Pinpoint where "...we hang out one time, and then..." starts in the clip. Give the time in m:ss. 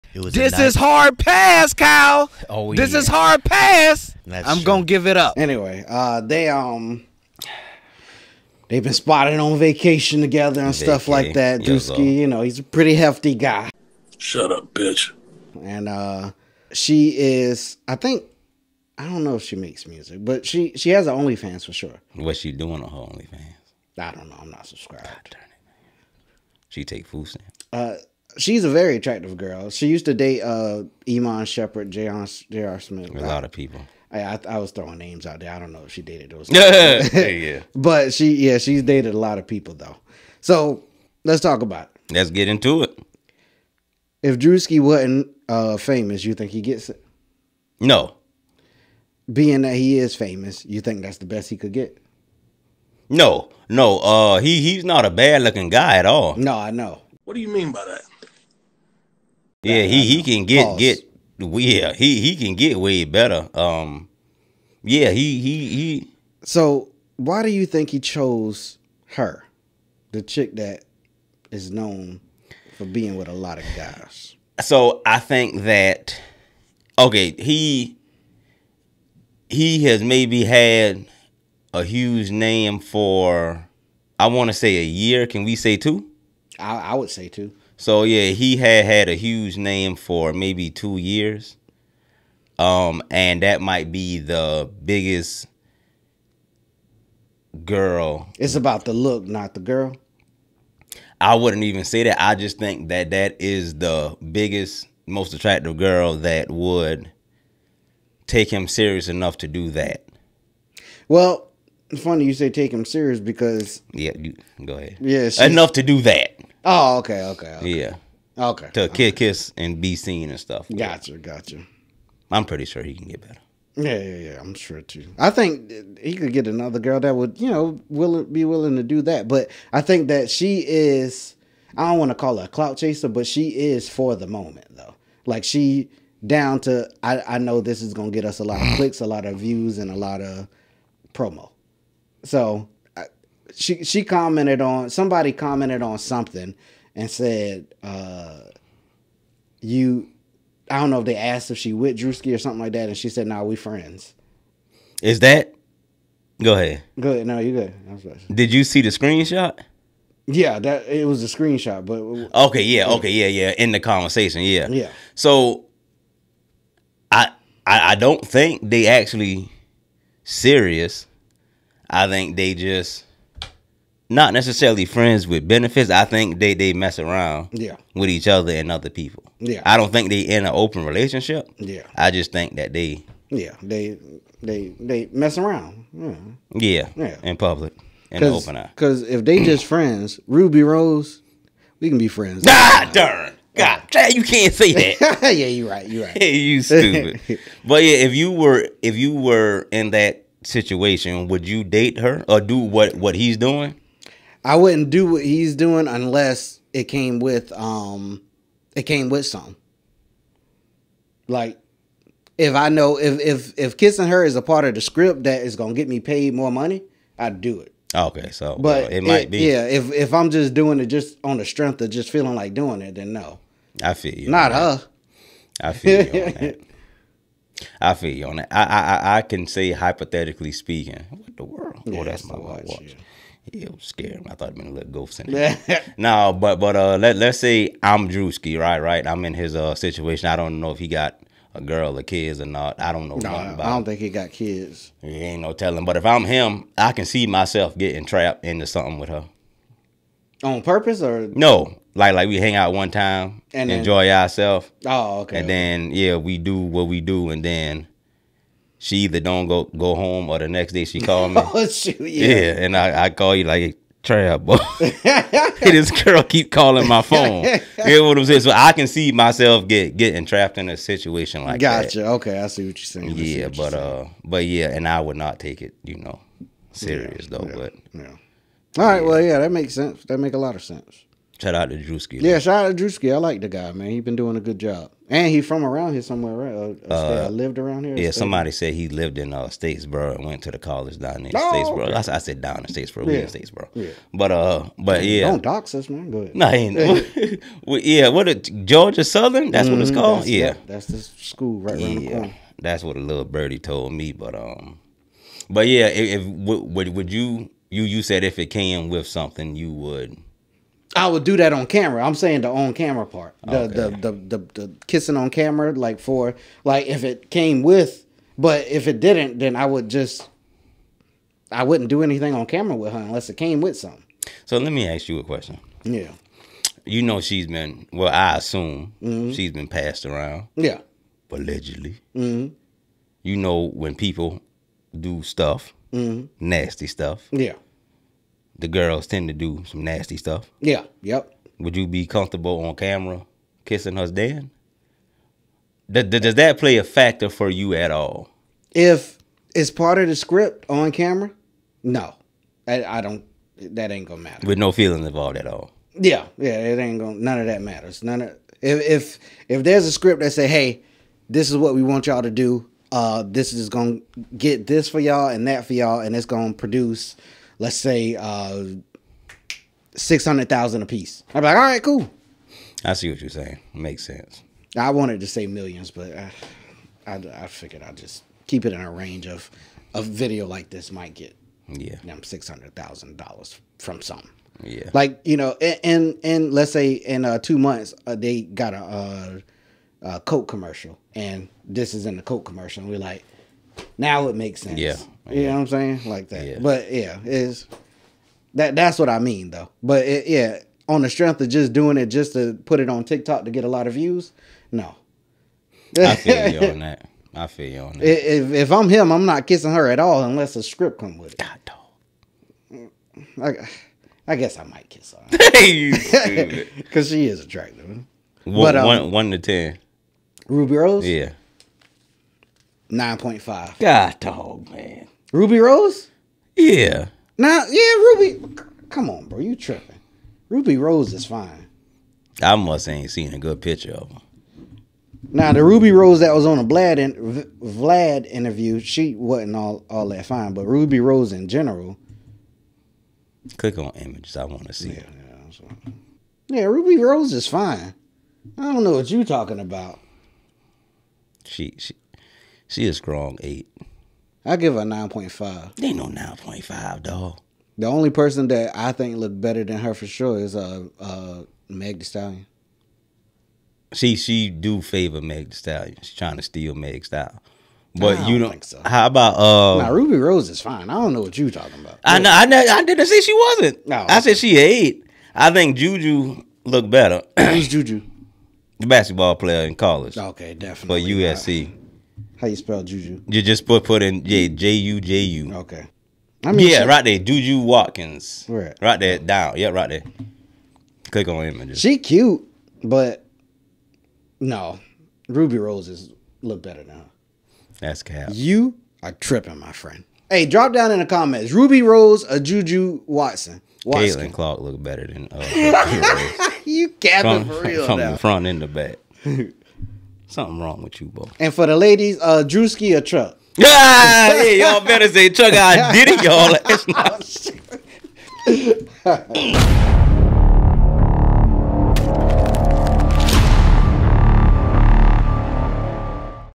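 4:12.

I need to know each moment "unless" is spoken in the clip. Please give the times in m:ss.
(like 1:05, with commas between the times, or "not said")
3:25, 5:22, 6:50.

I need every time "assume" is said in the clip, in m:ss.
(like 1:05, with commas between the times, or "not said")
5:28.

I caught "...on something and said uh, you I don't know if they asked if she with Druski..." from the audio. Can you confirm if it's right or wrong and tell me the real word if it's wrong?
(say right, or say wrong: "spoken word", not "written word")
right.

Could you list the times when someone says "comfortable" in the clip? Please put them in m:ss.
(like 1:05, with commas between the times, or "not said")
5:42.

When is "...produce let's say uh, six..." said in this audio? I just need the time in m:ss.
6:06.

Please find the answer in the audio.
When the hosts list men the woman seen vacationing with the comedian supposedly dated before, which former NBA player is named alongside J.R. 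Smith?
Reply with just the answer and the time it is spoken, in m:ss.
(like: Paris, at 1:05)
Iman Shumpert, at 0:31.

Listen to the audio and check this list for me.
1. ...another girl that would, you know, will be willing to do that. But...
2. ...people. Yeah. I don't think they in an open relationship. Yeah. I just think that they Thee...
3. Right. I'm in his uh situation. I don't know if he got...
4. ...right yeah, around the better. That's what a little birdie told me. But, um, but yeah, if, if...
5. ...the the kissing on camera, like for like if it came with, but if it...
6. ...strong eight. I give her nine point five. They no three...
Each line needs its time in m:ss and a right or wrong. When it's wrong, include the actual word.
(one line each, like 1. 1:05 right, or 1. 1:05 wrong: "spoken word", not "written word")
1. 2:06 right
2. 2:58 wrong: "Yeah", not "Thee"
3. 3:58 right
4. 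5:01 wrong: "corner", not "better"
5. 5:14 right
6. 7:32 wrong: "nine", not "three".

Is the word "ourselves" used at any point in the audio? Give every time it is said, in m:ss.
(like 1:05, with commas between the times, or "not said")
4:14.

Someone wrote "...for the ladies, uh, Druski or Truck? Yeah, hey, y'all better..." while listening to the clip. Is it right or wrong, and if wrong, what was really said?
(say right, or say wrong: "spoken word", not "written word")
right.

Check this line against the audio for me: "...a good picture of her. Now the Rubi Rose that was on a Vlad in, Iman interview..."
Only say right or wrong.
wrong.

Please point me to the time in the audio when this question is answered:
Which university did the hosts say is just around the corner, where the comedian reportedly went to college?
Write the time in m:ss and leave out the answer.
4:58.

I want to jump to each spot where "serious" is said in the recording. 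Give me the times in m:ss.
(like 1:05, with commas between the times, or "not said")
1:48, 1:52, 2:50, 4:36.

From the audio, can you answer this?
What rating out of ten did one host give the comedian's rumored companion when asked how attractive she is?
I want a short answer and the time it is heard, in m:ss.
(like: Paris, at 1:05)
9.5, at 7:02.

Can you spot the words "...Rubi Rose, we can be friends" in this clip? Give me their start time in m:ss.
3:10.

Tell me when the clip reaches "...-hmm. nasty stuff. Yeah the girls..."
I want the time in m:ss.
5:35.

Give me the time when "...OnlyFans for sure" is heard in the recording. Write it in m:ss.
0:21.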